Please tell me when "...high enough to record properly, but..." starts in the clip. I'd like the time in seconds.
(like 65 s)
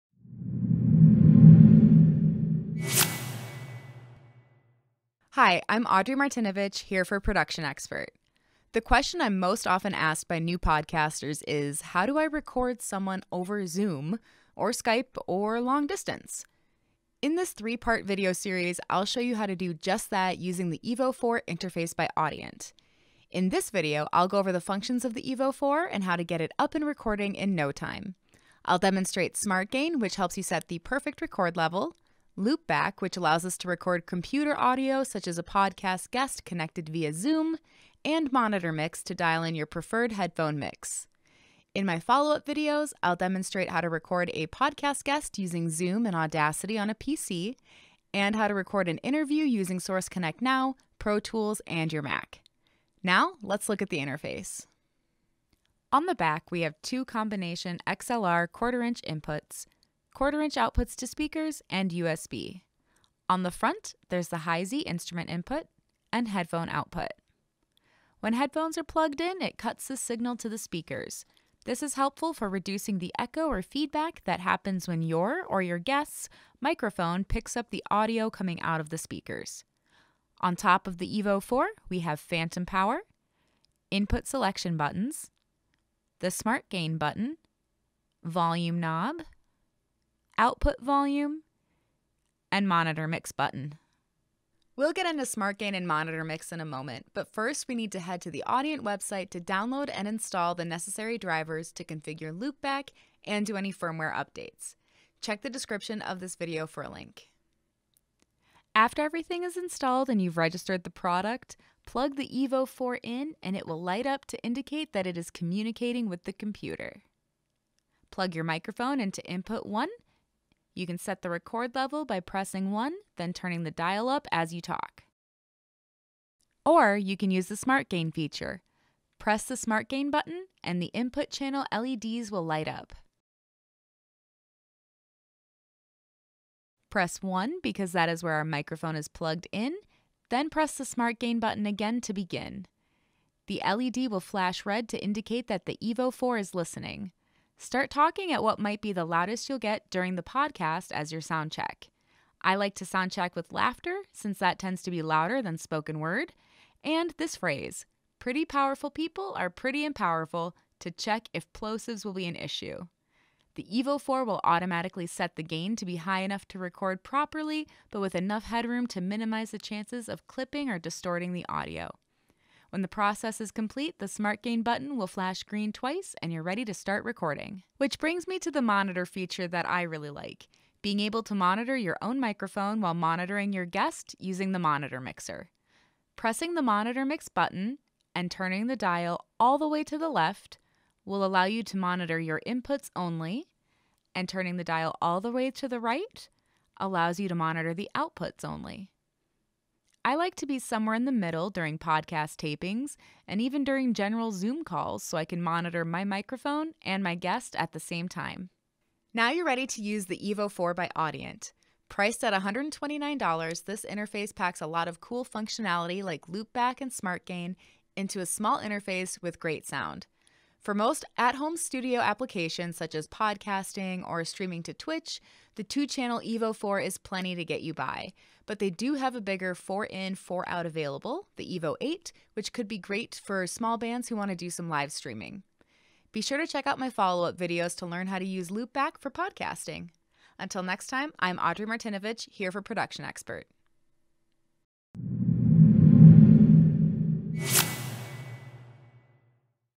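165 s.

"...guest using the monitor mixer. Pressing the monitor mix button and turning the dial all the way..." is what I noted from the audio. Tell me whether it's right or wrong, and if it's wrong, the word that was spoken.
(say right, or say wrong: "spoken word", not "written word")
right.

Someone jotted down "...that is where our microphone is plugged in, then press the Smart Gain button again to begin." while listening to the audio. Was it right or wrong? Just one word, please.
right.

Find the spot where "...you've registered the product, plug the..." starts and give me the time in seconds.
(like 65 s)
110 s.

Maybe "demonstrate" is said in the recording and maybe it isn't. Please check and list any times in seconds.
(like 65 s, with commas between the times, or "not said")
28 s, 43 s.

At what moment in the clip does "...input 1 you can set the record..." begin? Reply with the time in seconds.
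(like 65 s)
119 s.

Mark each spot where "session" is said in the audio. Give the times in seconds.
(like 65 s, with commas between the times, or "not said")
not said.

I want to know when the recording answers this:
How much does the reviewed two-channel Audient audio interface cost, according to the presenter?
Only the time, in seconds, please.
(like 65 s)
212 s.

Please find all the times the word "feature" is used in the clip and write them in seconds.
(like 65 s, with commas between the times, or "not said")
128 s, 179 s.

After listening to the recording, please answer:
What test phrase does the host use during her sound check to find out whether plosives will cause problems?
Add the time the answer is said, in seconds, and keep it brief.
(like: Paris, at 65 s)
pretty powerful people are pretty and powerful, at 158 s.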